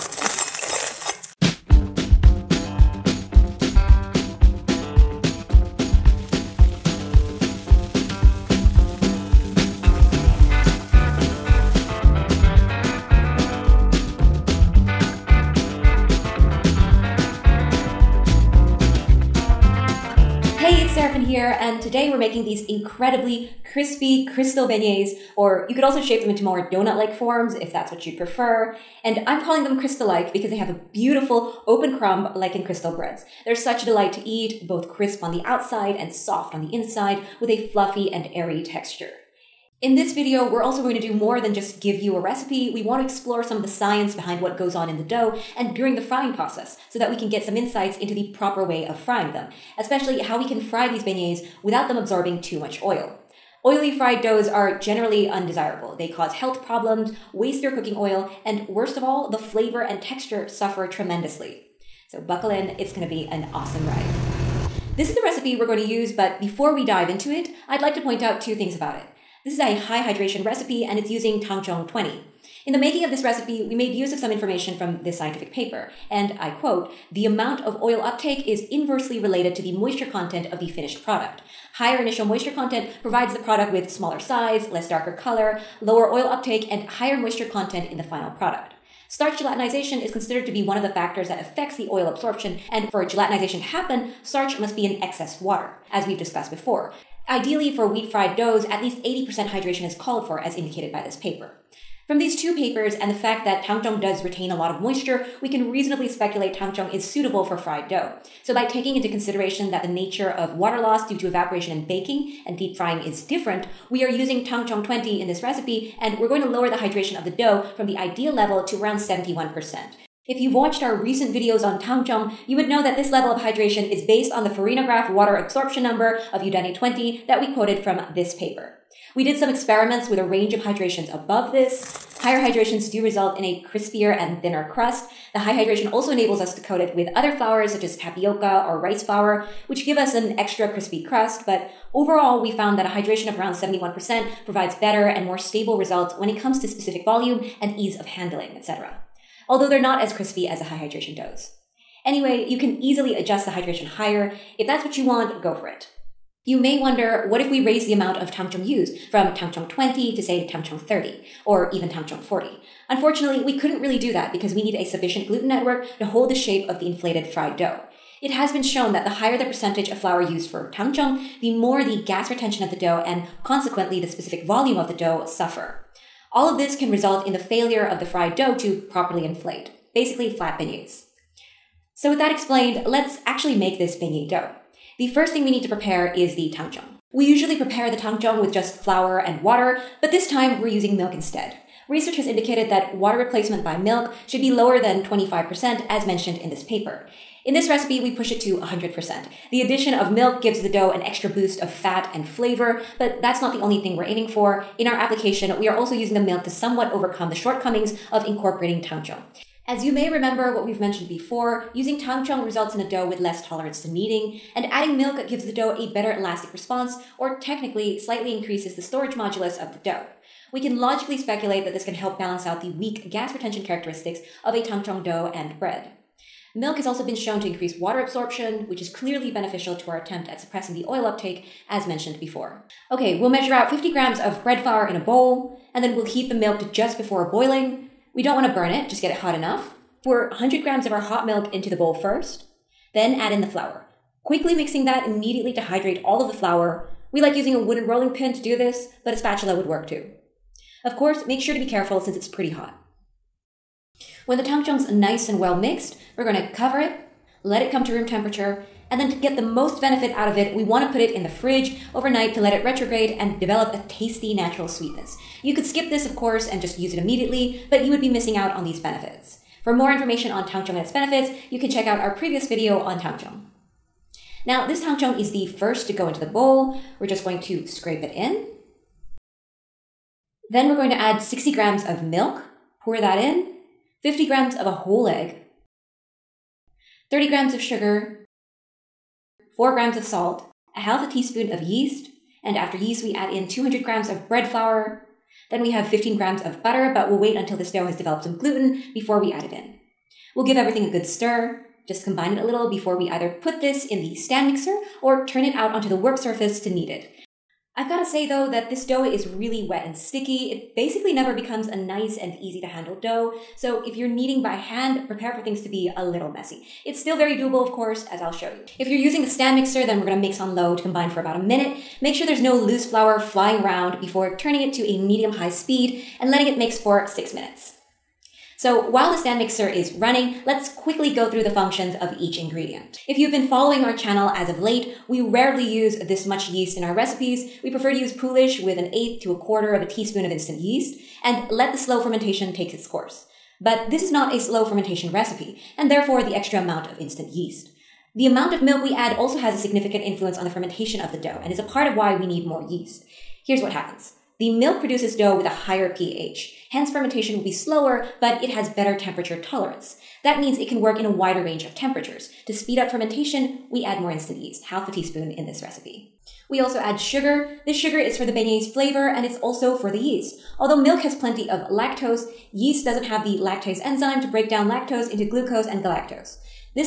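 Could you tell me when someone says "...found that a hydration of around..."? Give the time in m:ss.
2:22.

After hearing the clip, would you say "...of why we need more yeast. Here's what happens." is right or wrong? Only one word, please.
right.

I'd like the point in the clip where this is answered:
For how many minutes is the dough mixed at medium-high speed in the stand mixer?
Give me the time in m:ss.
5:27.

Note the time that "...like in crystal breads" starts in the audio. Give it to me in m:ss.
0:32.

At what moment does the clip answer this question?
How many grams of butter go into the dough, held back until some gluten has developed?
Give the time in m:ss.
4:55.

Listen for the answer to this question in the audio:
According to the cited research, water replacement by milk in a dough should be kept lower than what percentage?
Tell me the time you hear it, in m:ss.
3:15.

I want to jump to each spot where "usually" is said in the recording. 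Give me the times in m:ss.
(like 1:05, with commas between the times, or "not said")
3:07.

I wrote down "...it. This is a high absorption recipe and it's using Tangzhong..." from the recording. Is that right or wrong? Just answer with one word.
wrong.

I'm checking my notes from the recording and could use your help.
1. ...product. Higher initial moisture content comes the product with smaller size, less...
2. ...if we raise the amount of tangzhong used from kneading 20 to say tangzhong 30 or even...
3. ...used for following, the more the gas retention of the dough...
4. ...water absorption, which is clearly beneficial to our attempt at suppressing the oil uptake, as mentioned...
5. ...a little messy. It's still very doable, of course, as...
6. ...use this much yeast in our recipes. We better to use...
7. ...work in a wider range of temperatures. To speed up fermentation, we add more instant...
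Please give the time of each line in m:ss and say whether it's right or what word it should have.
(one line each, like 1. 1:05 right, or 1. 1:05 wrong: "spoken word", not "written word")
1. 1:21 wrong: "provides", not "comes"
2. 2:37 wrong: "tangzhong", not "kneading"
3. 2:50 wrong: "tangzhong", not "following"
4. 3:47 right
5. 5:15 right
6. 5:35 wrong: "prefer", not "better"
7. 6:00 right.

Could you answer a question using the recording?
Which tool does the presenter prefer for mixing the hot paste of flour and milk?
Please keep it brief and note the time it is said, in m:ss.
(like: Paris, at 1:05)
wooden rolling pin, at 4:07.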